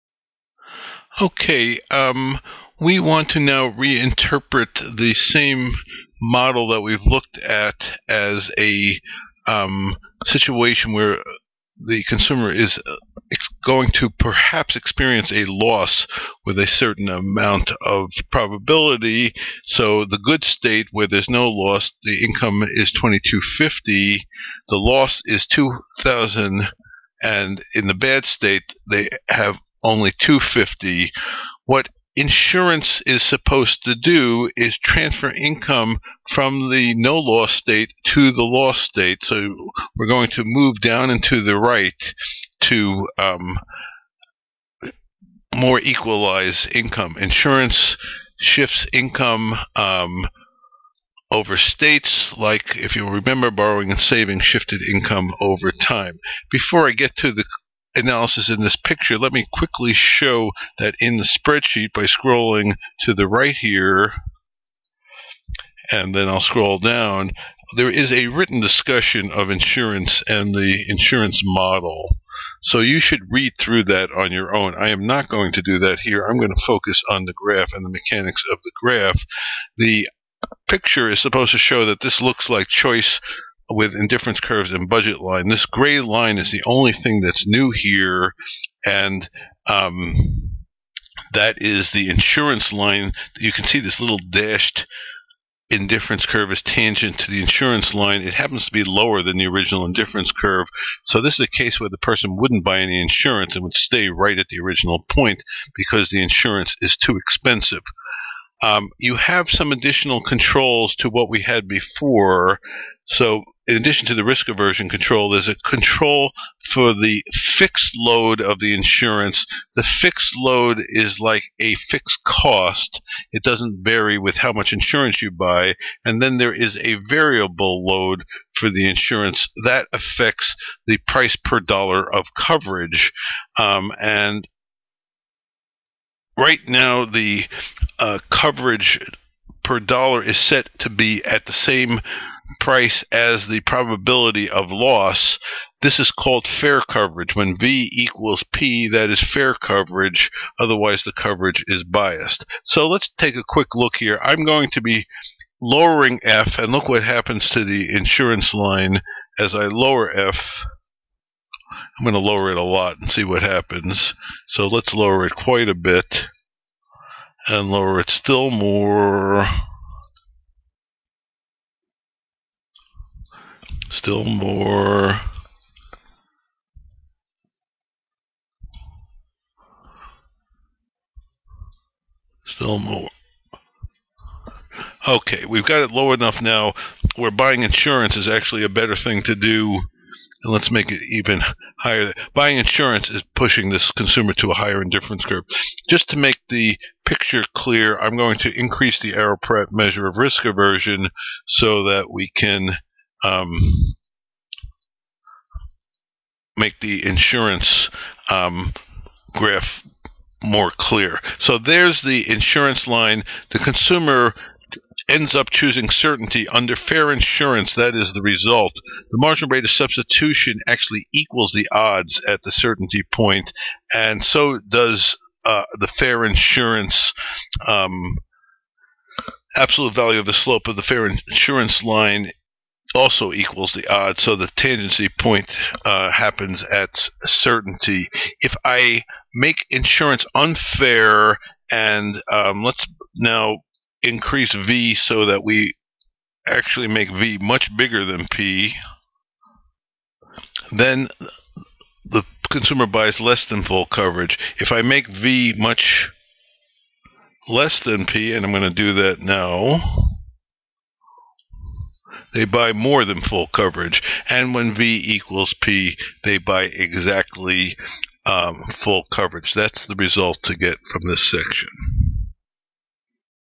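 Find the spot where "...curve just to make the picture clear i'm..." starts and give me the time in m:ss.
3:15.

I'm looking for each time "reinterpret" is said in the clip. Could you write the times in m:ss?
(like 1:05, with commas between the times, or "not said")
0:03.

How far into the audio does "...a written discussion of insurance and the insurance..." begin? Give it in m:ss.
1:08.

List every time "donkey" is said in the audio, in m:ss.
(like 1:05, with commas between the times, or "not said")
not said.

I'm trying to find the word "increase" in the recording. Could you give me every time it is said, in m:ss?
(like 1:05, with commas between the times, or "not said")
3:18, 4:04.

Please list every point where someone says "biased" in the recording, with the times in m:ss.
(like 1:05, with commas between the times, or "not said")
2:31.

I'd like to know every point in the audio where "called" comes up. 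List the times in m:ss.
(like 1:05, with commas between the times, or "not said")
2:26.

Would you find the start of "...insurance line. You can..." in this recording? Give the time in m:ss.
1:32.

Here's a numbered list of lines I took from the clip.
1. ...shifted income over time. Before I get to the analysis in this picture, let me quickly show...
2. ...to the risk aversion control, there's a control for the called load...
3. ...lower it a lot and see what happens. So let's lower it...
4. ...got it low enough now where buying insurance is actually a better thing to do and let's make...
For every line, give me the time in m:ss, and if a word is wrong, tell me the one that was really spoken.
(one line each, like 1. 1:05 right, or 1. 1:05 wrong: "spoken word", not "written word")
1. 0:54 right
2. 1:54 wrong: "fixed", not "called"
3. 2:42 right
4. 3:05 right.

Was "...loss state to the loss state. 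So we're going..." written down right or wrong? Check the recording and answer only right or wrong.
right.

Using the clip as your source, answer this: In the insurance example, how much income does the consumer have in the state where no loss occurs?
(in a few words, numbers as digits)
2250.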